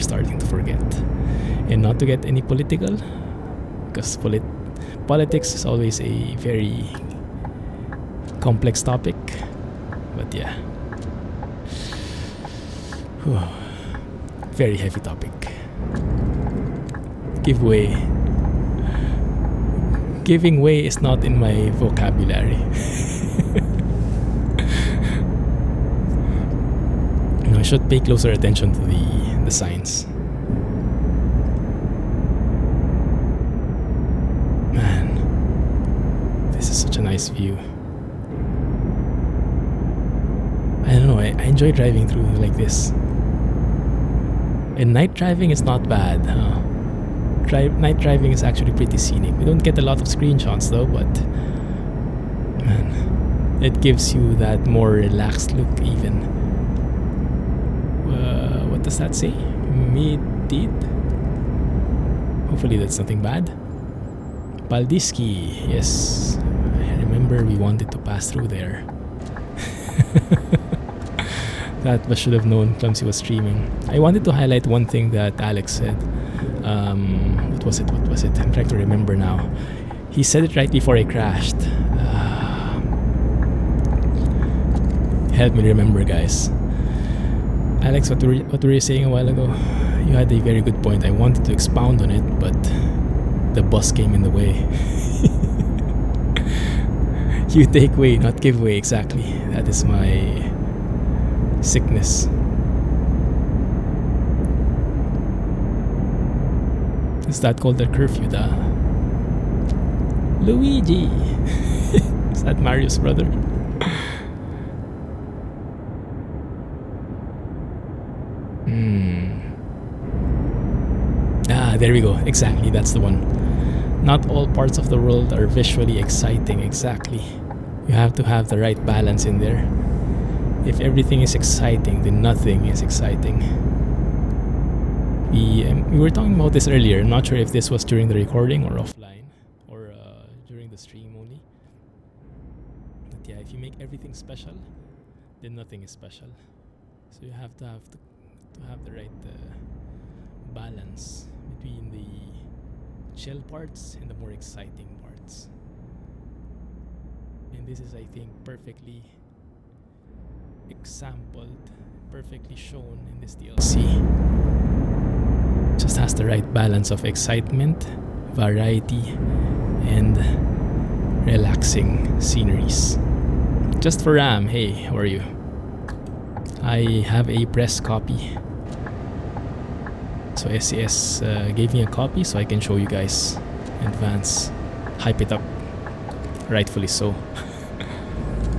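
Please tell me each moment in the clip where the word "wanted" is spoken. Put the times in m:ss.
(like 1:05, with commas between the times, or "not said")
1:07, 1:13, 1:31.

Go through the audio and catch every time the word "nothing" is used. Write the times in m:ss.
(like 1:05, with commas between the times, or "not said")
1:02, 2:12, 2:25.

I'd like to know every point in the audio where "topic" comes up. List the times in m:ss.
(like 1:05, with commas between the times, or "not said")
0:08, 0:14.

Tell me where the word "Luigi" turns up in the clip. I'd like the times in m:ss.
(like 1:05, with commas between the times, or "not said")
1:50.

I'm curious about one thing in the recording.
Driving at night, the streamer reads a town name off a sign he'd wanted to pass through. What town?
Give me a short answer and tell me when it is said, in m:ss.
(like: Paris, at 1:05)
Paldiski, at 1:04.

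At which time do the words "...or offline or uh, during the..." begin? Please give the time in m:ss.
2:18.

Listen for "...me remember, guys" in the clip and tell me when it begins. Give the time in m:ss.
1:25.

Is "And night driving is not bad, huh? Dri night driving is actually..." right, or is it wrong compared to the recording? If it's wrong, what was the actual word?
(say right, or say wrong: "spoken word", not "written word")
right.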